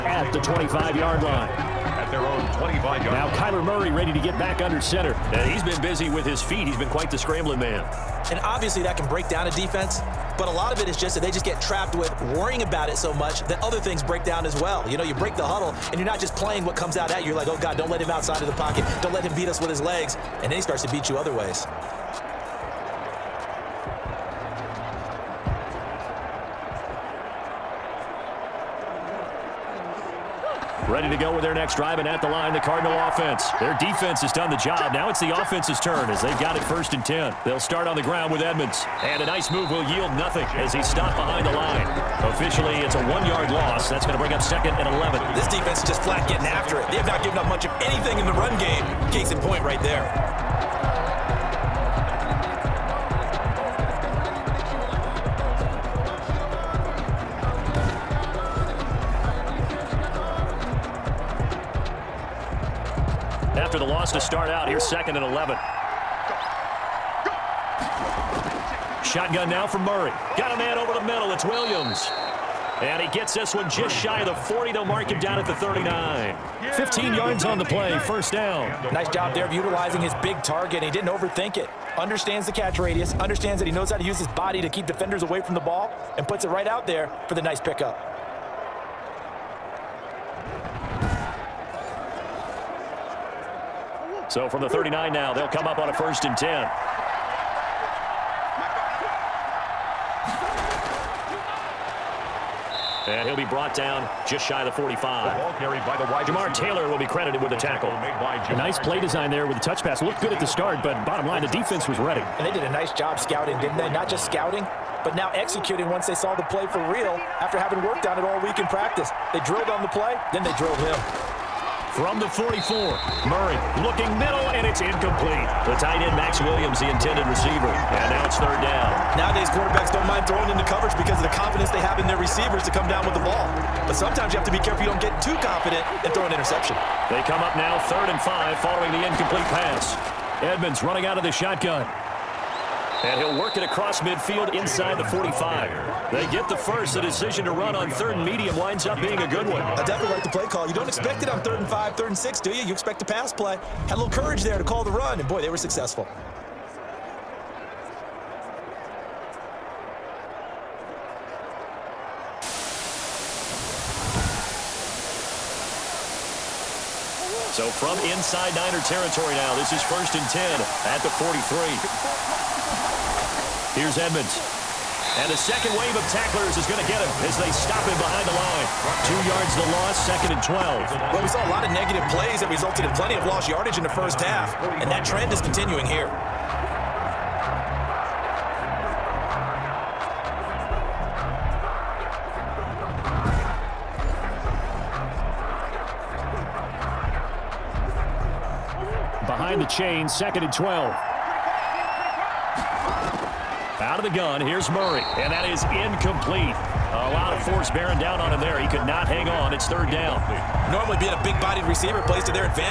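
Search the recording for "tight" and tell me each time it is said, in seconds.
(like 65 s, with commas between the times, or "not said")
125 s.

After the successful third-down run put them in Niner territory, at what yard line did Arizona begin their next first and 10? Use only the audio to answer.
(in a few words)
43.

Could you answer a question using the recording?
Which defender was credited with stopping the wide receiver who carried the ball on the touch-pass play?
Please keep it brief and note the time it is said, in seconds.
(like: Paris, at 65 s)
Taylor, at 106 s.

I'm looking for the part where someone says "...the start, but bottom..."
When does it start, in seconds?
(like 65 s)
110 s.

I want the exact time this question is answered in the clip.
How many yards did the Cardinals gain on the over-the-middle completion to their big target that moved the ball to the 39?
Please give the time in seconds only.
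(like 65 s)
76 s.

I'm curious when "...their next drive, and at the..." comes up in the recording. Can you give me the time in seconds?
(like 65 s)
31 s.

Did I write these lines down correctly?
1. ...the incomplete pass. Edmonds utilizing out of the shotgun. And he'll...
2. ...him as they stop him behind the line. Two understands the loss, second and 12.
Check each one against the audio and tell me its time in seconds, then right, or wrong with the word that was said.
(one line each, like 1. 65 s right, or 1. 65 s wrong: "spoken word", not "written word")
1. 138 s wrong: "running", not "utilizing"
2. 176 s wrong: "yards", not "understands".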